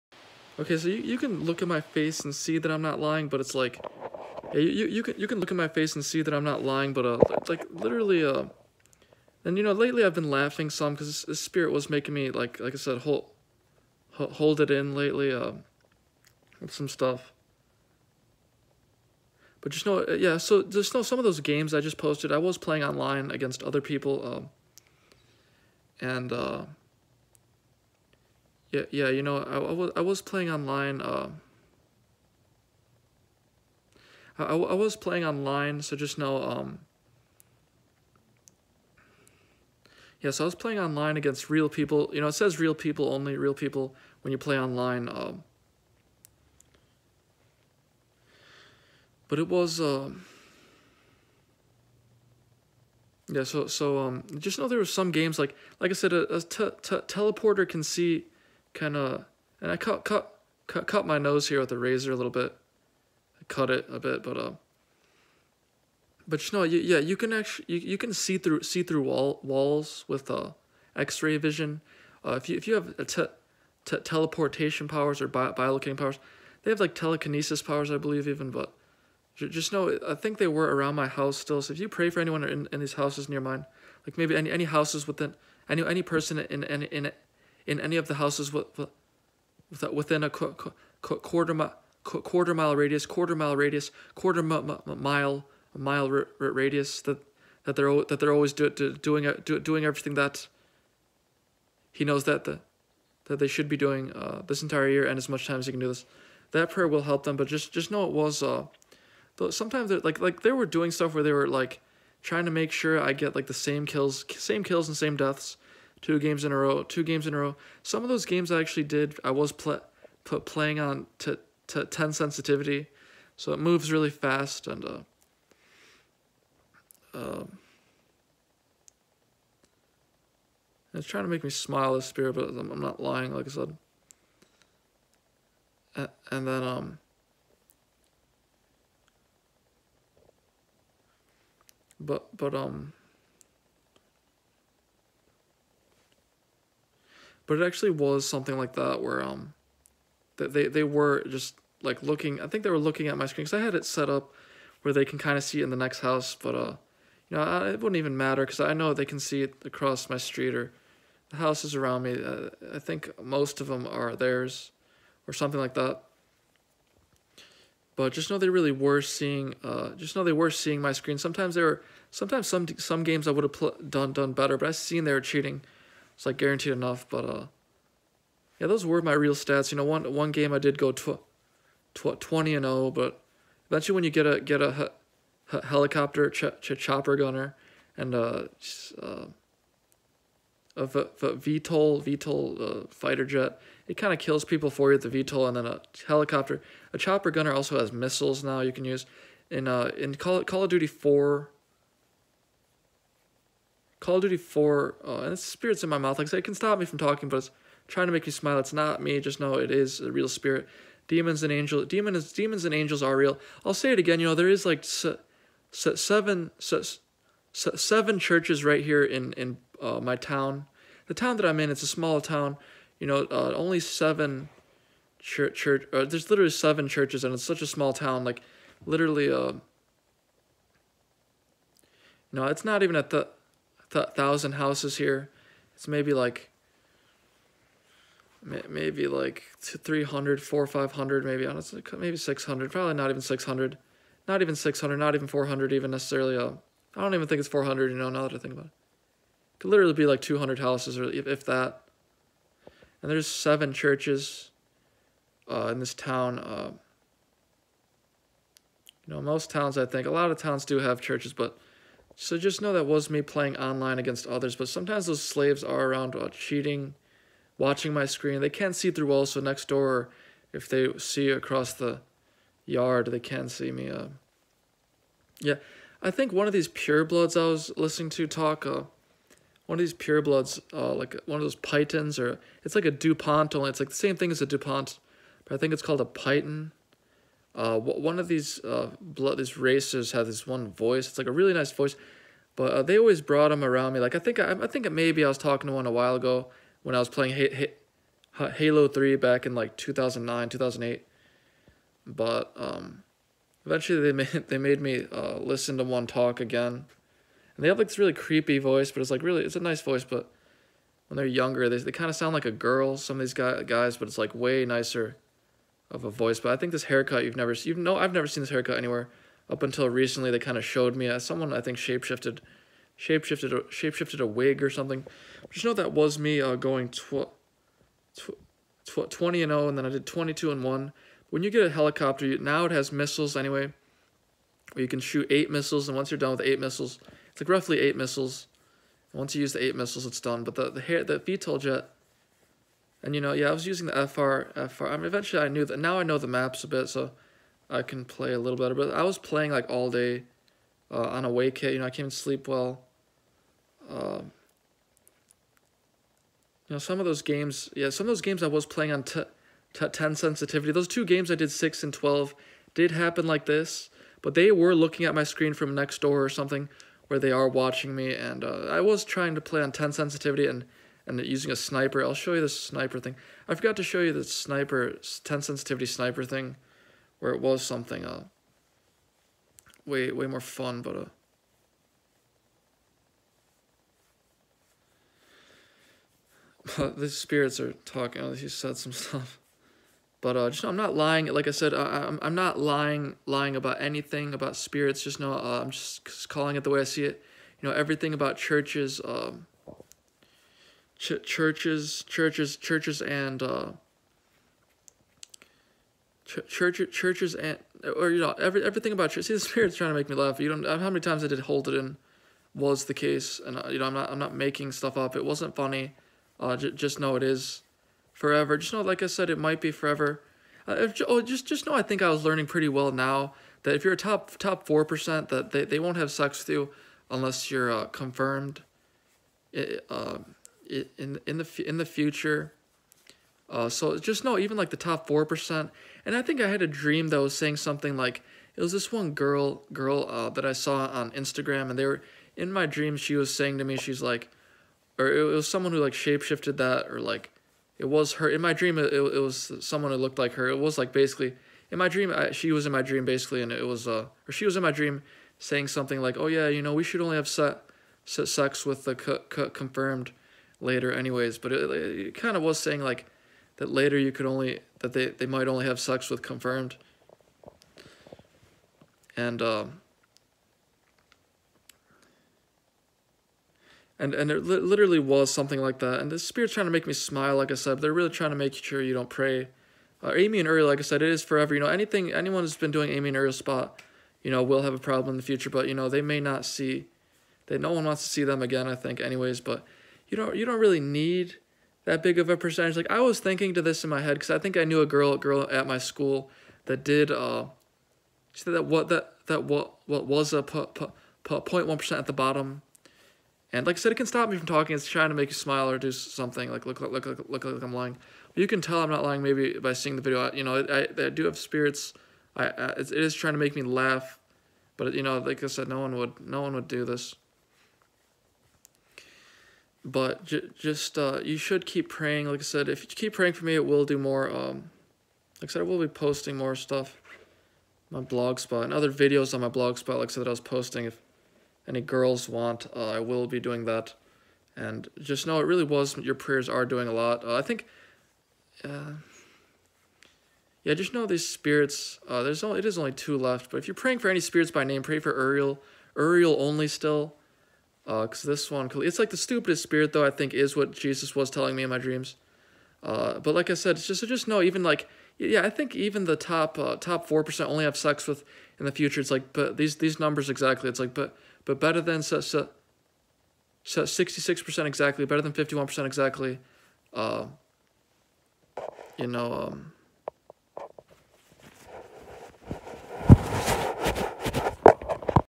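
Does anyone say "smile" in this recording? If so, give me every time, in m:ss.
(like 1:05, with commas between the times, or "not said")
2:11, 3:28, 7:56, 8:25.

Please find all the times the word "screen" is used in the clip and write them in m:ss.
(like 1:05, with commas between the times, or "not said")
2:33, 2:50, 4:28, 6:05.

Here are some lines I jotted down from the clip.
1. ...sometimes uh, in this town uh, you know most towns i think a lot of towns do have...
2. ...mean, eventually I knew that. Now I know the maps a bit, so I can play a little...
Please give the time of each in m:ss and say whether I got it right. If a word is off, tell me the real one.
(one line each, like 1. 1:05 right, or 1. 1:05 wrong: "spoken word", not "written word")
1. 4:13 wrong: "churches", not "sometimes"
2. 5:44 right.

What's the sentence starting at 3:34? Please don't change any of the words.
You know, there is like se, se, seven se, seven churches right here in, in uh, my town.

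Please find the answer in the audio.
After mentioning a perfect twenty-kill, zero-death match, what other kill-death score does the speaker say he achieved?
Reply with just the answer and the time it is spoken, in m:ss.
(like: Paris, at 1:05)
22 and 1, at 5:30.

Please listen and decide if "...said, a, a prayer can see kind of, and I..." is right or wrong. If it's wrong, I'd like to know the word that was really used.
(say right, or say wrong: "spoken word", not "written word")
wrong: "teleporter", not "prayer".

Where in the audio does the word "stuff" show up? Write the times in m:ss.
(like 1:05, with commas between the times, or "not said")
0:16, 1:50, 6:28, 6:54, 8:46.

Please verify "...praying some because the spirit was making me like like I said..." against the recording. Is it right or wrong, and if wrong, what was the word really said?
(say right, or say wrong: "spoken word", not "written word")
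wrong: "laughing", not "praying".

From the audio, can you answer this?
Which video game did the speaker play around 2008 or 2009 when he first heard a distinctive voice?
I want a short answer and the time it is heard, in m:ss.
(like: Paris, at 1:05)
Halo 3, at 4:58.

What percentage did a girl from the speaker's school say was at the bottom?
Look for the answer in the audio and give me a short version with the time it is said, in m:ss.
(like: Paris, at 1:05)
0.1%, at 8:20.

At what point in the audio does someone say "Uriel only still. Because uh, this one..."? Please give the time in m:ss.
9:05.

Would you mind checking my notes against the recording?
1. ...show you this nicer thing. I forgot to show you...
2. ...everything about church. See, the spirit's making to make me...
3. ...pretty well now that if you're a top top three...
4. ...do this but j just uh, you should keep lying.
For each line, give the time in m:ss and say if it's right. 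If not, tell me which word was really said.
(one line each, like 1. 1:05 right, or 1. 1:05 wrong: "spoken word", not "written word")
1. 6:12 wrong: "sniper", not "nicer"
2. 6:48 wrong: "trying", not "making"
3. 7:02 wrong: "four", not "three"
4. 8:36 wrong: "praying", not "lying".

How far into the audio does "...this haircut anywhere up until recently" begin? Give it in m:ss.
5:18.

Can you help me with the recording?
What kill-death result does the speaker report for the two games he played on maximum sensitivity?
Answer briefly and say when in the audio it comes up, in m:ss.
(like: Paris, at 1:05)
6 and 12, at 6:01.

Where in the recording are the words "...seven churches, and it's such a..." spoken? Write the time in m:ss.
3:46.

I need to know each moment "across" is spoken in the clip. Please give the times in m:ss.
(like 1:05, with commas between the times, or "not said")
2:39, 4:31.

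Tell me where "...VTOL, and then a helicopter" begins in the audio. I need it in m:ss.
3:15.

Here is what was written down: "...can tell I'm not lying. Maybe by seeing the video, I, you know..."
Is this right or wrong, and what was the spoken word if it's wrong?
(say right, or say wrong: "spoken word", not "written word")
right.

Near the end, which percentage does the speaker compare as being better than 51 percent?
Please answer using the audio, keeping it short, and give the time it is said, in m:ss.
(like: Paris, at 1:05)
66%, at 9:23.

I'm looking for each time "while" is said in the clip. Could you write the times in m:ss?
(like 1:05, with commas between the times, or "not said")
4:55.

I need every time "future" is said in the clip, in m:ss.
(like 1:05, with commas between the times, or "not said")
7:11, 8:05, 9:18.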